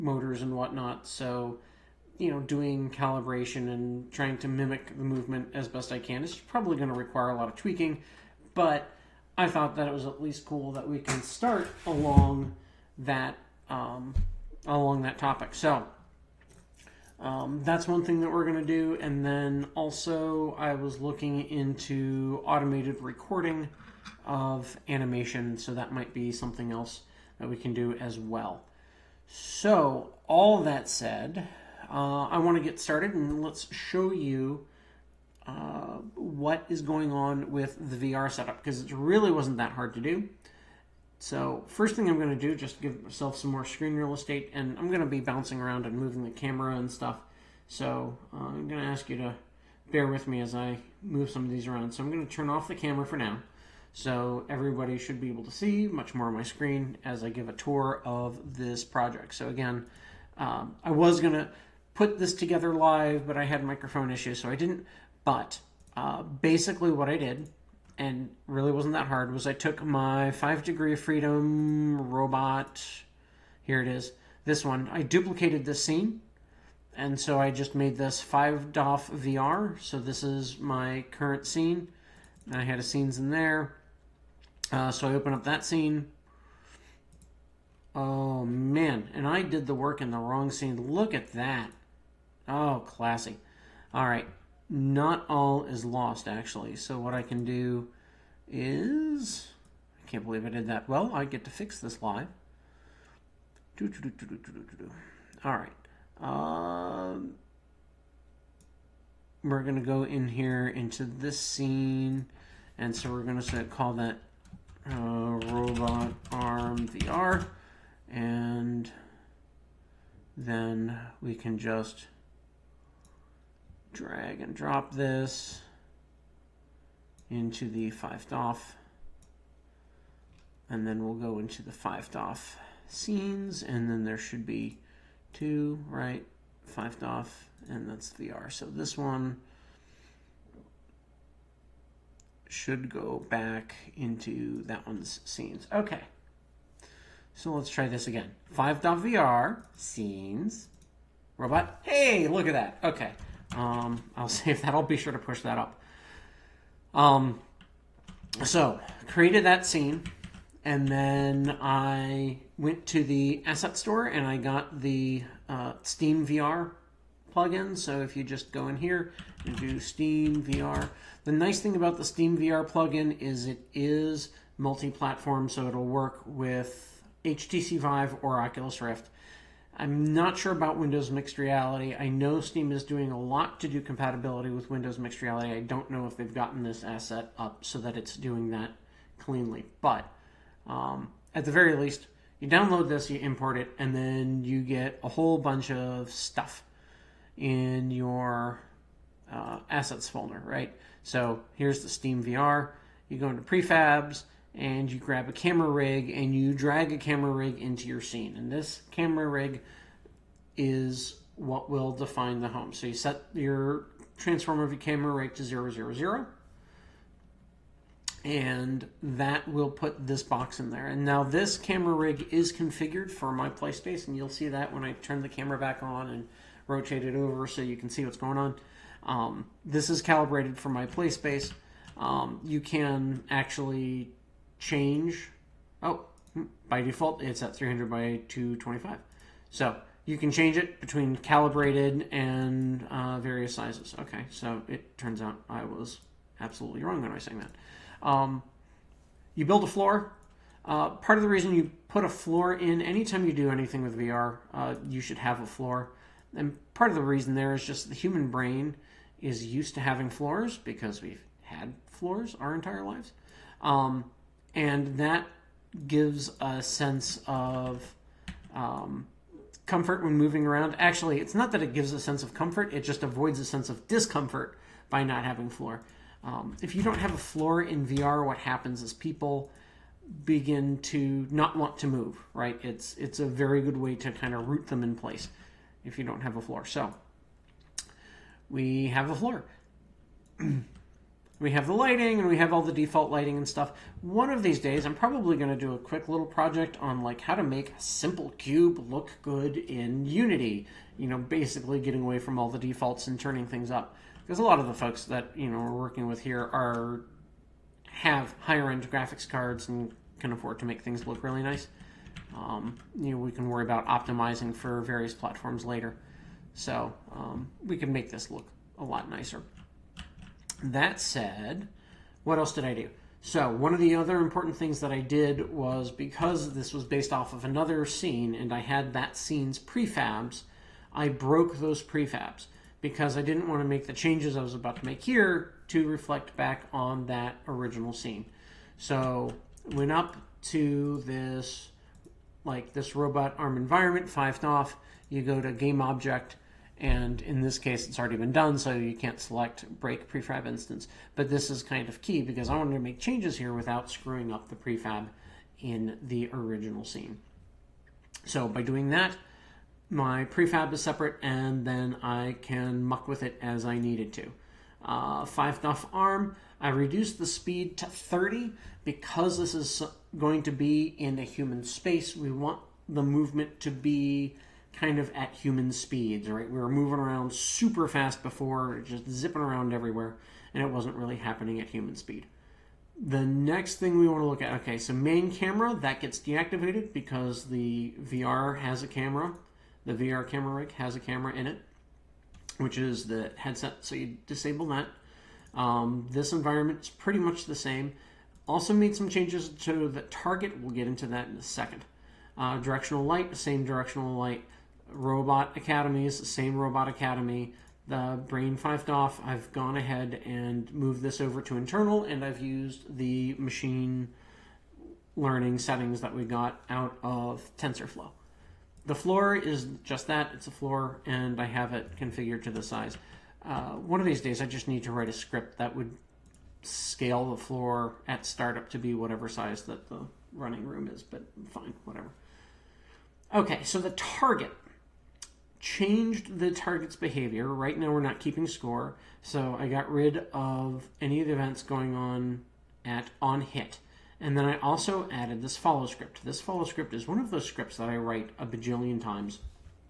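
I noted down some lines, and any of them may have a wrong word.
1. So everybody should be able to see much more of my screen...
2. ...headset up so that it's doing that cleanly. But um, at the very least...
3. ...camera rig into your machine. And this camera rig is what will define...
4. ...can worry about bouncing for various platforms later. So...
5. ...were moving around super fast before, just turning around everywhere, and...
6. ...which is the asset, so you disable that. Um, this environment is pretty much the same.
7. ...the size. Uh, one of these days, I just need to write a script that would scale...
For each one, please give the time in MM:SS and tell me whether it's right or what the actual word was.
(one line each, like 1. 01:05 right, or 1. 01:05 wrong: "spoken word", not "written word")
1. 00:53 right
2. 03:06 wrong: "asset", not "headset"
3. 03:26 wrong: "scene", not "machine"
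4. 05:13 wrong: "optimizing", not "bouncing"
5. 06:16 wrong: "zipping", not "turning"
6. 06:32 wrong: "headset", not "asset"
7. 07:02 right.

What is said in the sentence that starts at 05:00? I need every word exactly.
You know, basically getting away from all the defaults and turning things up.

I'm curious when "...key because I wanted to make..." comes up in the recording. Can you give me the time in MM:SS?
05:52.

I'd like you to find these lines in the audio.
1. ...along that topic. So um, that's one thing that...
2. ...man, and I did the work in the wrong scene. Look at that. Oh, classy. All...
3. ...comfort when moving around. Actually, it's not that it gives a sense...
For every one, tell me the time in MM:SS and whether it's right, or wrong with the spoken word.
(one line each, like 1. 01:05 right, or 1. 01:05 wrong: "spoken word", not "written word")
1. 00:14 right
2. 01:28 right
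3. 04:29 right.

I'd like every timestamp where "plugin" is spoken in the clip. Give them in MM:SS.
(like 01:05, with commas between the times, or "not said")
02:47, 02:52.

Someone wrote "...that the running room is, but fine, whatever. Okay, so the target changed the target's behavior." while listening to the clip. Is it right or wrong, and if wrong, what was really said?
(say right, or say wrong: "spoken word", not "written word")
right.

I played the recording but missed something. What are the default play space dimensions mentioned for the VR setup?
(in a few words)
300 by 225.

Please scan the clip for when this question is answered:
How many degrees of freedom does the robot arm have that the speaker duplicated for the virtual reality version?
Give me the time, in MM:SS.
01:10.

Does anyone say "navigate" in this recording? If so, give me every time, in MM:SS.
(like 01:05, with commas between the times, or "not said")
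not said.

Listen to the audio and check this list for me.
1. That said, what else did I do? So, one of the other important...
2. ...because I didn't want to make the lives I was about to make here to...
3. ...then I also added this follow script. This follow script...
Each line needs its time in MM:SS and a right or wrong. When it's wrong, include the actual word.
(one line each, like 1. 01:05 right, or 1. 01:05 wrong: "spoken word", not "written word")
1. 05:20 right
2. 05:32 wrong: "changes", not "lives"
3. 07:24 right.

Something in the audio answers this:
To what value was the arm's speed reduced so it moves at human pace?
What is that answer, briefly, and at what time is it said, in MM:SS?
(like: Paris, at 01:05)
30, at 06:07.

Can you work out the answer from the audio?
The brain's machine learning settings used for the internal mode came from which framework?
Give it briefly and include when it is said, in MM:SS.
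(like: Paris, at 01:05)
TensorFlow, at 06:57.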